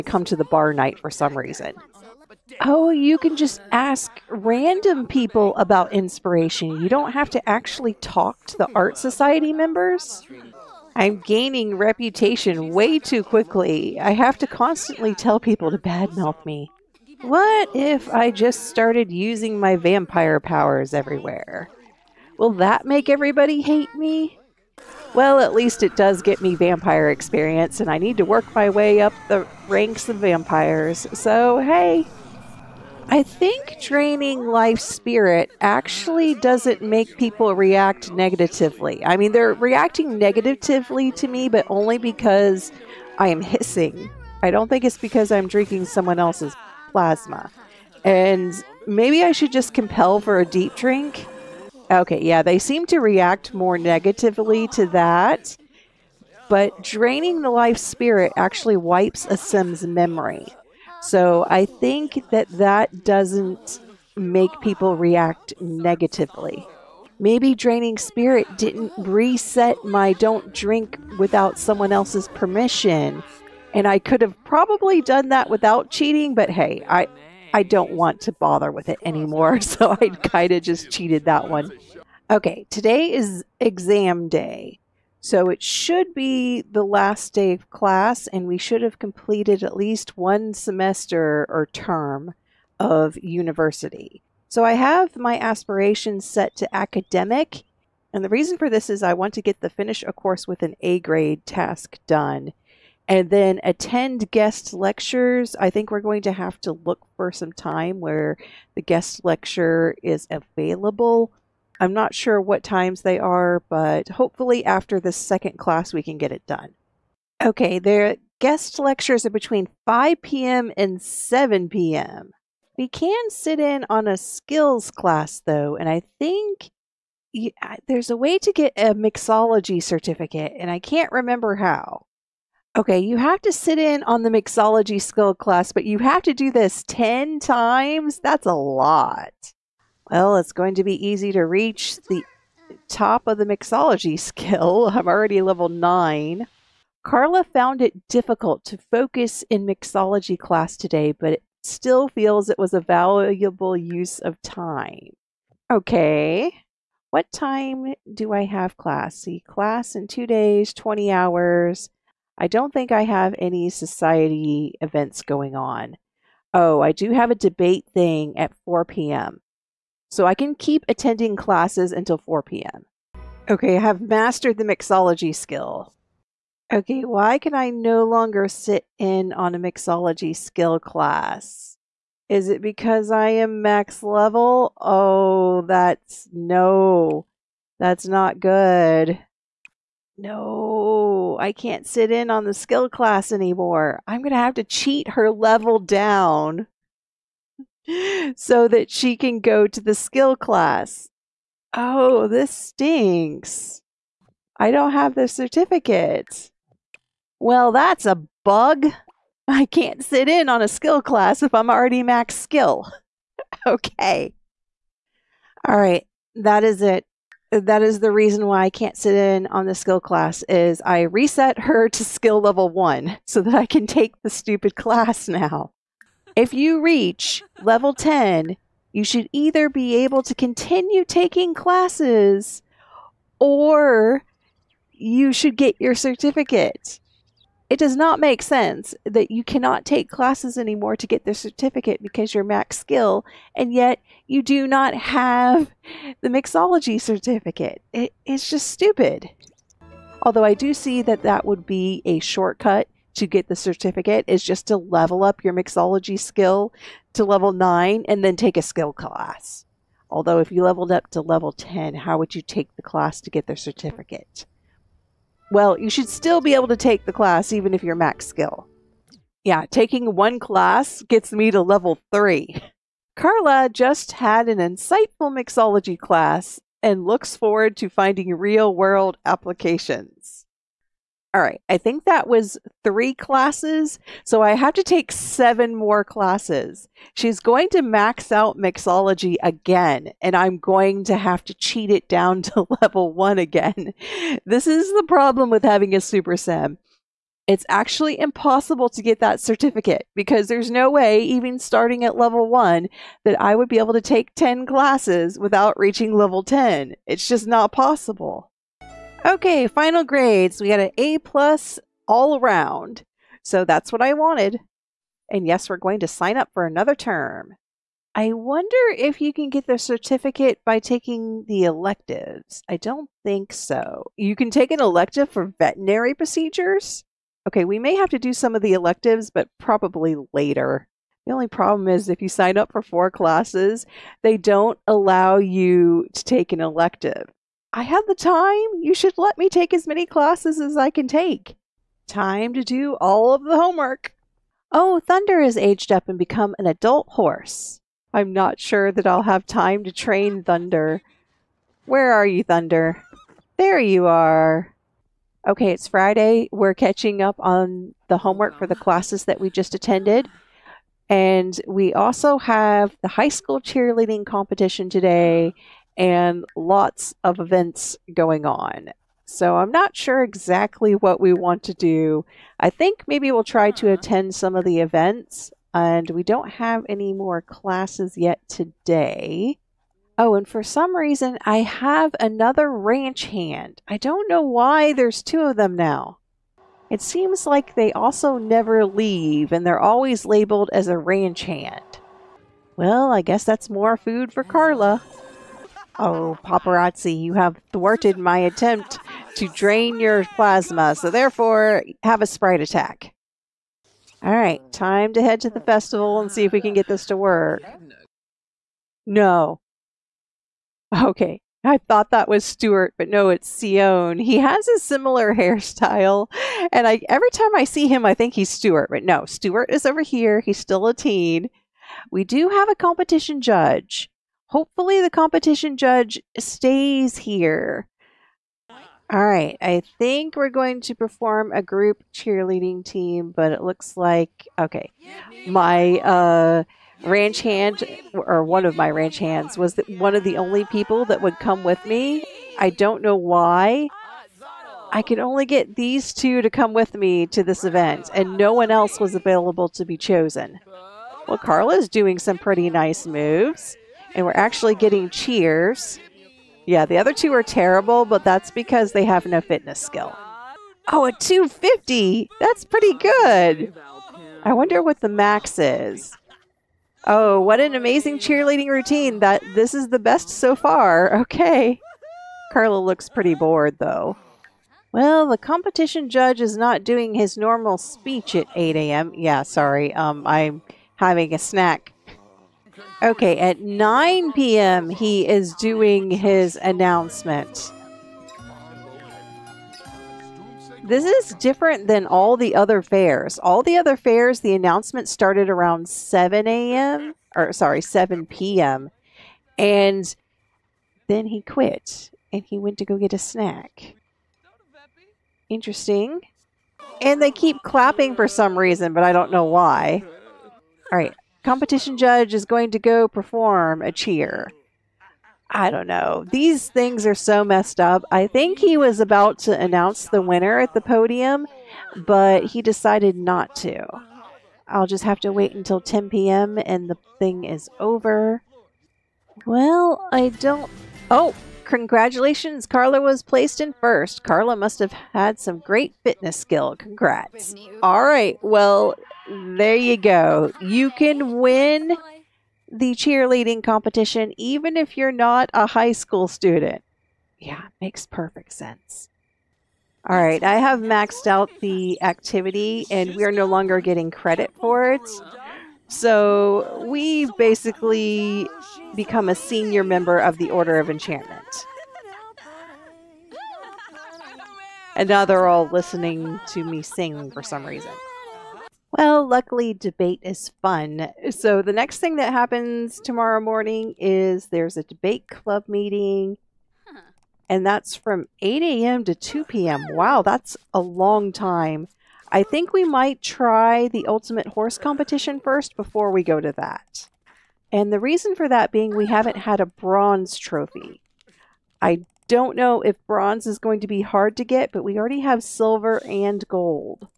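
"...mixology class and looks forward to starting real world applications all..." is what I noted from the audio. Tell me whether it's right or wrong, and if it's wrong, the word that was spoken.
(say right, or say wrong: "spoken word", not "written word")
wrong: "finding", not "starting".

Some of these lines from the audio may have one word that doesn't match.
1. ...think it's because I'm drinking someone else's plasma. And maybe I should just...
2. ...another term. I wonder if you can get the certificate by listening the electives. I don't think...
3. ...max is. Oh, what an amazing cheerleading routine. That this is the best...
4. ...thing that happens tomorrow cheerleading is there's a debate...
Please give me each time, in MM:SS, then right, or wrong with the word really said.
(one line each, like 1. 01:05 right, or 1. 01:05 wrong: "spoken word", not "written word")
1. 00:44 right
2. 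05:16 wrong: "taking", not "listening"
3. 07:45 right
4. 09:31 wrong: "morning", not "cheerleading".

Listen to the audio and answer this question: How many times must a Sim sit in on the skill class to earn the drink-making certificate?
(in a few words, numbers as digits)
10.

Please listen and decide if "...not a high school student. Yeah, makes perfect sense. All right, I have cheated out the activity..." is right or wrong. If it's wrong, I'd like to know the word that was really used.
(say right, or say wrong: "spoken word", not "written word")
wrong: "maxed", not "cheated".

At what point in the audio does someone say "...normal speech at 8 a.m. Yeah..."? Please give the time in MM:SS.
07:57.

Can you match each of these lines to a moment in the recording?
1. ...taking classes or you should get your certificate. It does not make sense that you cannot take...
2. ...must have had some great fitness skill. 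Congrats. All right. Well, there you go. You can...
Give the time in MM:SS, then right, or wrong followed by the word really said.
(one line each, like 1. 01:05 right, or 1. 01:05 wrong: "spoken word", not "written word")
1. 03:51 right
2. 08:54 right.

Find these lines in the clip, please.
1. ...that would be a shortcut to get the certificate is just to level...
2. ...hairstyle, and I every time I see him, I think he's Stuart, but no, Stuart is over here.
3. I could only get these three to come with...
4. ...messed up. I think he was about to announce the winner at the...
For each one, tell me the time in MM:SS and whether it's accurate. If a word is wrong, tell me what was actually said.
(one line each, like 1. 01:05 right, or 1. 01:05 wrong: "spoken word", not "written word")
1. 04:11 right
2. 06:55 right
3. 07:24 wrong: "two", not "three"
4. 08:37 right.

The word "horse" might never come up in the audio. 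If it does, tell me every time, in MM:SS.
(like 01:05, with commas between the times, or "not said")
05:47, 09:44.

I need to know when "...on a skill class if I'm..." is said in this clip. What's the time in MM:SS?
03:30.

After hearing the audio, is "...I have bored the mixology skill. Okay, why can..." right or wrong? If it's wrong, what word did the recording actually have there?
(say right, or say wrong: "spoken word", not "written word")
wrong: "mastered", not "bored".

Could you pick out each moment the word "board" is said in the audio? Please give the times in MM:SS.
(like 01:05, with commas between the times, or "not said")
not said.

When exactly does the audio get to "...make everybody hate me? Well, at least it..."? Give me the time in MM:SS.
00:22.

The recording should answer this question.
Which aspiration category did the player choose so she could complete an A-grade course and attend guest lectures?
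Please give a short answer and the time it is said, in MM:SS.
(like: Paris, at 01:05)
Academic, at 01:36.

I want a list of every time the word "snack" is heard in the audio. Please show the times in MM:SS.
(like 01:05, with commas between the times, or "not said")
08:01, 08:23.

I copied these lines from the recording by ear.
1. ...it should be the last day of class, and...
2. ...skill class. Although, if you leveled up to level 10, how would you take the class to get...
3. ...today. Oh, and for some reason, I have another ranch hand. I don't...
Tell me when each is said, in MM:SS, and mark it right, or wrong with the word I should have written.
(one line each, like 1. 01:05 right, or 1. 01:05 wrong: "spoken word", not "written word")
1. 01:25 right
2. 04:18 right
3. 06:18 right.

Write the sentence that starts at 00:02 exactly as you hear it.
Oh, you can just ask random people about inspiration.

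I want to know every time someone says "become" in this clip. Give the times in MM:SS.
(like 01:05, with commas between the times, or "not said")
05:46, 09:18.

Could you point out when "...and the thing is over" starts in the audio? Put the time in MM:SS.
08:46.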